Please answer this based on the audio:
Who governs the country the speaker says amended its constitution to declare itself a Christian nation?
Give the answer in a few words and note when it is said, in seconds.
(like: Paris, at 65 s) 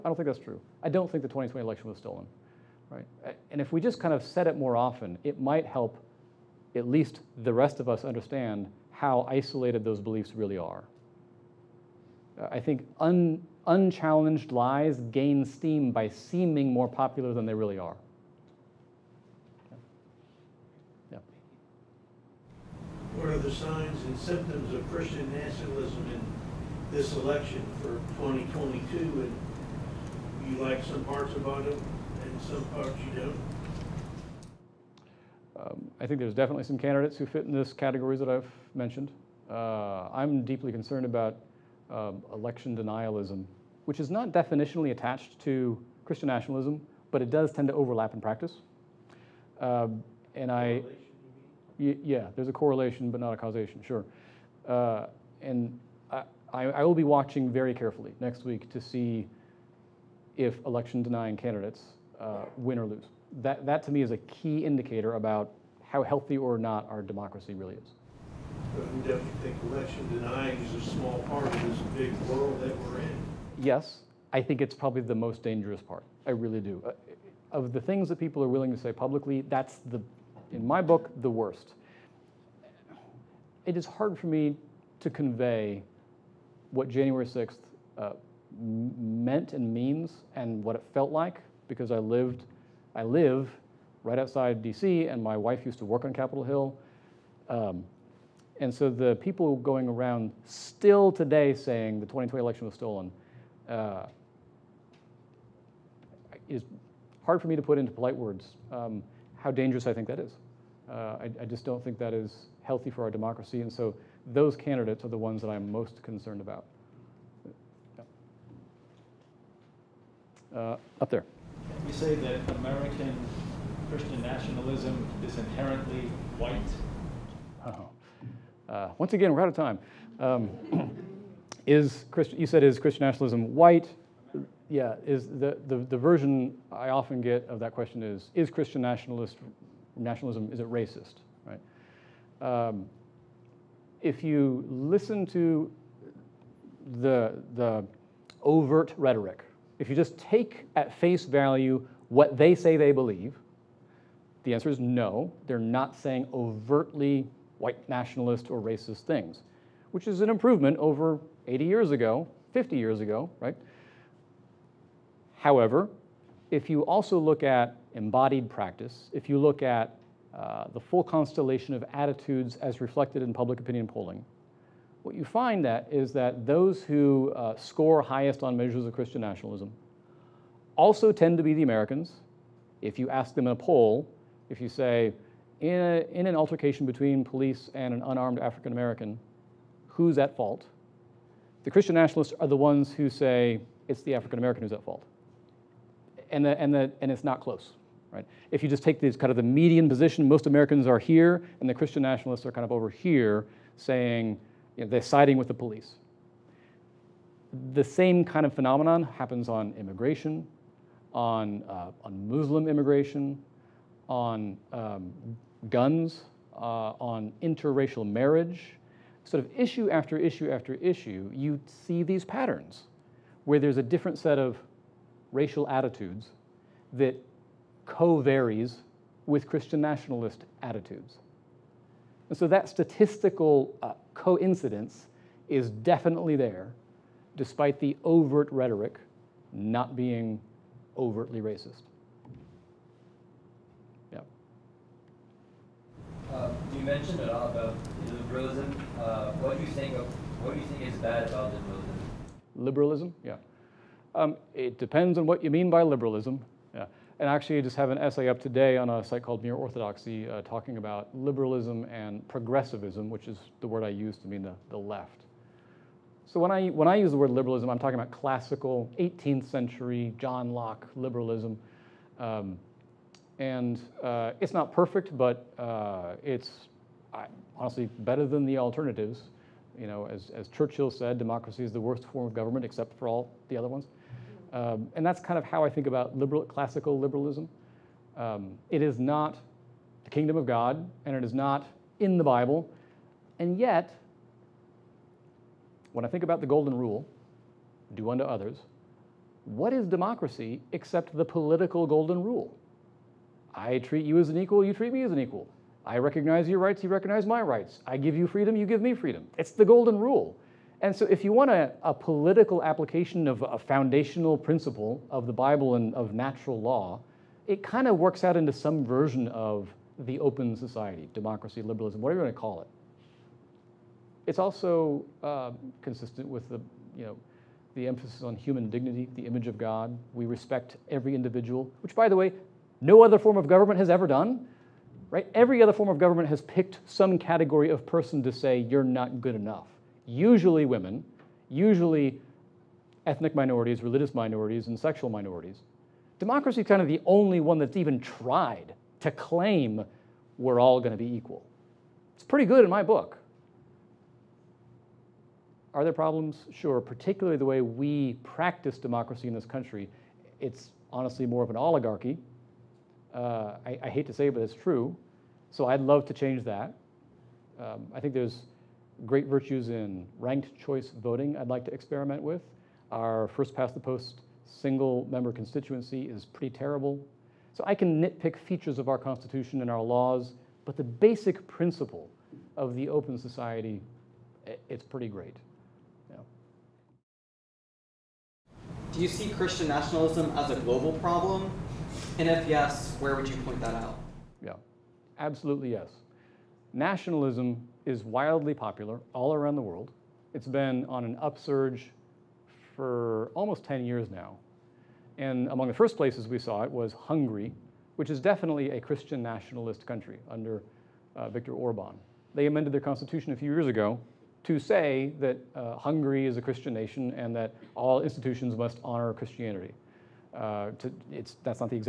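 Viktor Orban, at 411 s.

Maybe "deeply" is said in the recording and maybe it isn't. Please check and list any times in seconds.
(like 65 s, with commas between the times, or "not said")
40 s.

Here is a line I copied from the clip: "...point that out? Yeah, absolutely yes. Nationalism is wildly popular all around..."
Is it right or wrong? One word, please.
right.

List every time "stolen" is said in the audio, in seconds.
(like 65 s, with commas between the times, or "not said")
1 s, 102 s.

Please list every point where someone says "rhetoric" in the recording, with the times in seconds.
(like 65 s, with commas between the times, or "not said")
148 s, 238 s.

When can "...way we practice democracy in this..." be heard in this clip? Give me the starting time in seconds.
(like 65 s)
357 s.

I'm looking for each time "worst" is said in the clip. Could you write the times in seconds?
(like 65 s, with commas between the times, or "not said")
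81 s, 281 s.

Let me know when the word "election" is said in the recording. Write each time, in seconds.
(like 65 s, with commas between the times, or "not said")
1 s, 27 s, 42 s, 60 s, 69 s, 102 s.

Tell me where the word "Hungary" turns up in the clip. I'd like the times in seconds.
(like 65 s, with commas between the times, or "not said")
406 s, 415 s.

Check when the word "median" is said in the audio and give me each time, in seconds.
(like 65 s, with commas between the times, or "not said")
199 s.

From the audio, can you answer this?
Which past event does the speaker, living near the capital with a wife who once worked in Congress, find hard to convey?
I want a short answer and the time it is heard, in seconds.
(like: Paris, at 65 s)
January 6th, at 86 s.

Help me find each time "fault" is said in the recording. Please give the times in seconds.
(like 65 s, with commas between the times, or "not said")
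190 s, 194 s.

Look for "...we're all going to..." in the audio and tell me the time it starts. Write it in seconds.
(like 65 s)
350 s.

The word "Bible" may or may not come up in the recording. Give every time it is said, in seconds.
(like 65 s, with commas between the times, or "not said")
292 s, 315 s.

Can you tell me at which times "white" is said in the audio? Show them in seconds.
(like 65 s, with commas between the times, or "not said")
126 s, 133 s, 157 s.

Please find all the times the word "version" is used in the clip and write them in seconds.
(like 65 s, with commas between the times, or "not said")
135 s, 318 s.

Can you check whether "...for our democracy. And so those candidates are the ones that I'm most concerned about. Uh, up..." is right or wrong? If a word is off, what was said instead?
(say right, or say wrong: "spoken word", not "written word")
right.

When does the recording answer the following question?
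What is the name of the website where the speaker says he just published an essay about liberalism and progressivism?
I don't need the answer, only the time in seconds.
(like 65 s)
259 s.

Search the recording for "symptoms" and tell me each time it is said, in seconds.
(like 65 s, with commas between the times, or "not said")
24 s.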